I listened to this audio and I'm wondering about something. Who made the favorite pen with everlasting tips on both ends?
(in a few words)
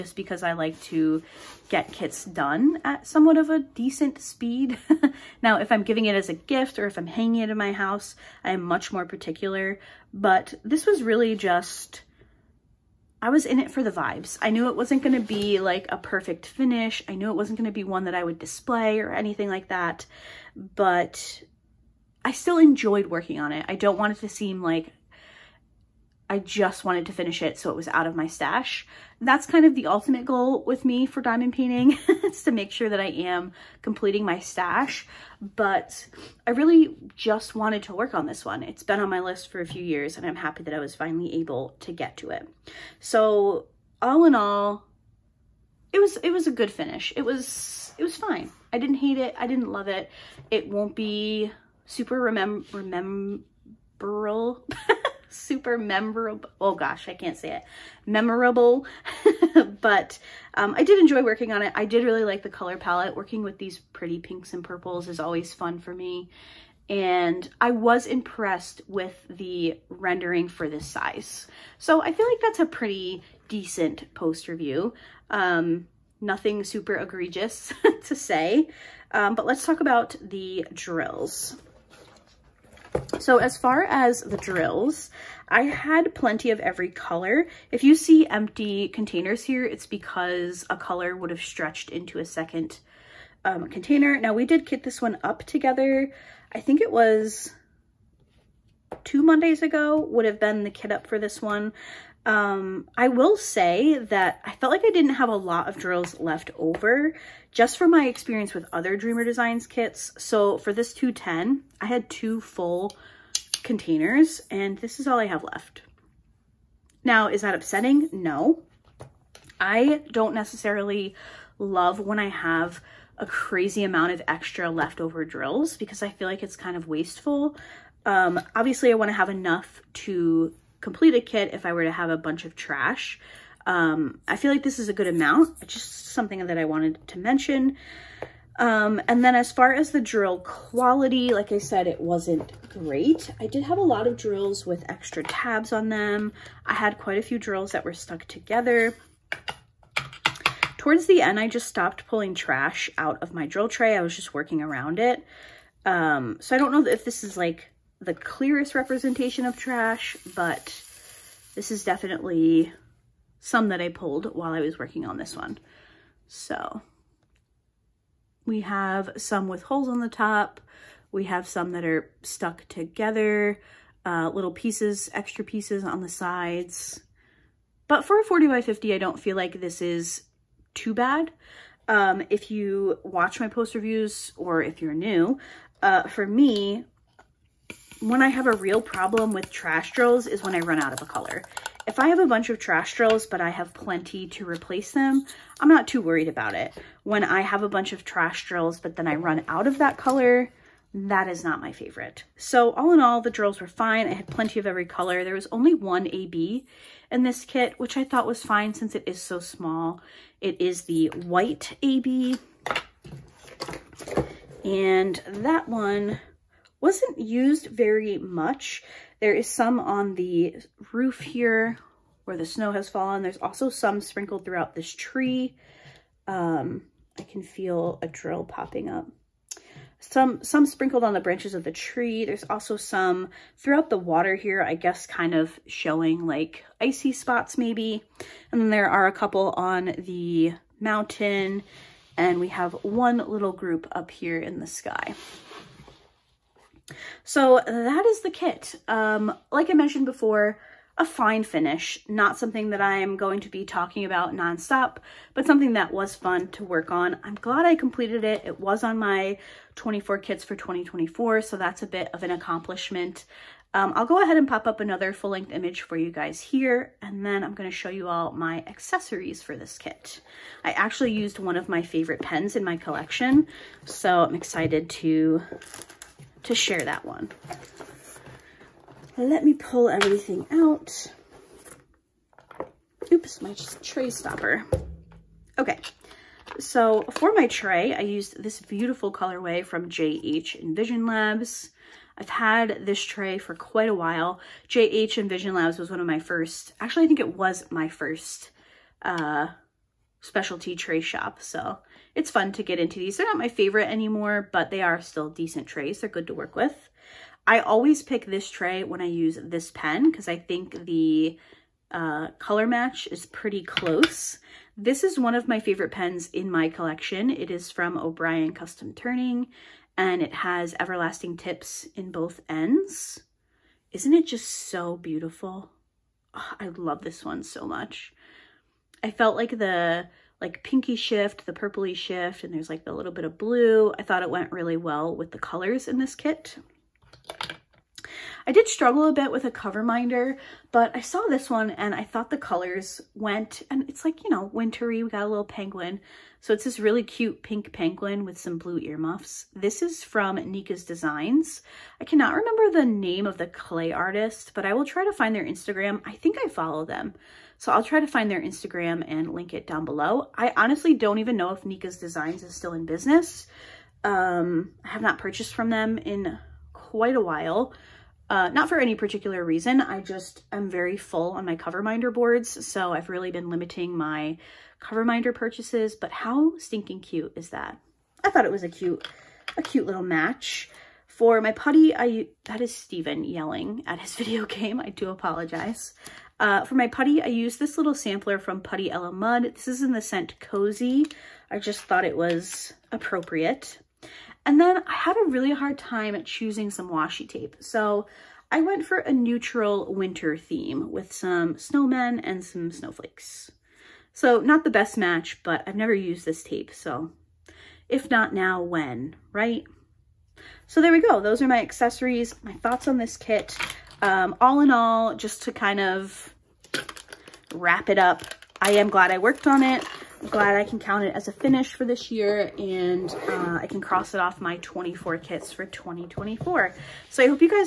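O'Brien Custom Turning.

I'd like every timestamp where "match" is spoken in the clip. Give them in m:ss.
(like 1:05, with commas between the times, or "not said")
5:12, 6:20, 6:44.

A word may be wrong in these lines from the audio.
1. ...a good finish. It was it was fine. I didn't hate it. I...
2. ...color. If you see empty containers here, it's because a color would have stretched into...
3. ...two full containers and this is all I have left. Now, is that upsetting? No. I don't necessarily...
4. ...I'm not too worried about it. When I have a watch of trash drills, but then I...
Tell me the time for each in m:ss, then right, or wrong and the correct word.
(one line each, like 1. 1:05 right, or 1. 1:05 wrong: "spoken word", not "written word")
1. 0:46 right
2. 1:26 right
3. 1:52 right
4. 3:15 wrong: "bunch", not "watch".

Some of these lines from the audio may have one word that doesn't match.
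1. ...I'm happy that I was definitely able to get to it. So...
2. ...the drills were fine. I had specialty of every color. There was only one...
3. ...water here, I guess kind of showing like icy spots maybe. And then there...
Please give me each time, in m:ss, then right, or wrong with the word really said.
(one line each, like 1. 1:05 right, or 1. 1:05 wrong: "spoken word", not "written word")
1. 0:40 wrong: "finally", not "definitely"
2. 3:23 wrong: "plenty", not "specialty"
3. 3:53 right.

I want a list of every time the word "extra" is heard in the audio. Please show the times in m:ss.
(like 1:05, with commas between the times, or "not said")
2:04, 2:24, 2:55.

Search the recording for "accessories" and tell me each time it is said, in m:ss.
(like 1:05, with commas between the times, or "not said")
4:28, 6:51.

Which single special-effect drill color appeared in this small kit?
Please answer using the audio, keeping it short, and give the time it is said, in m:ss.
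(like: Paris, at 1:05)
white AB, at 3:31.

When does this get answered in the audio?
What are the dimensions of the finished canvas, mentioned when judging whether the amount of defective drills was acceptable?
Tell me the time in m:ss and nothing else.
2:58.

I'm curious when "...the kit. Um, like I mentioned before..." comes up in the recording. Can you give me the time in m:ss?
4:08.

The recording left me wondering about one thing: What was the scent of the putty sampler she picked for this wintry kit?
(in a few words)
Cozy.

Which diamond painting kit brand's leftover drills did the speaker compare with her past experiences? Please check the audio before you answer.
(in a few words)
Dreamer Designs.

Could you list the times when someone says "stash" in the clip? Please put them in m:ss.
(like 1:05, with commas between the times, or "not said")
0:28, 0:34.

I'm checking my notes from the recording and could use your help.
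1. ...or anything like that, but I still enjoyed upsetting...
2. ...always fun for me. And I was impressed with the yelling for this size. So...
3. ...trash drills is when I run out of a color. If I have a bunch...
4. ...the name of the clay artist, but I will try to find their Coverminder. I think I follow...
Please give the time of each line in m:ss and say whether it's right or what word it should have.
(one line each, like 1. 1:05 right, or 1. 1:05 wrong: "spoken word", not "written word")
1. 0:19 wrong: "working", not "upsetting"
2. 1:05 wrong: "rendering", not "yelling"
3. 3:09 right
4. 5:52 wrong: "Instagram", not "Coverminder".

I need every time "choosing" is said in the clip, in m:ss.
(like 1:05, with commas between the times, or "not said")
6:36.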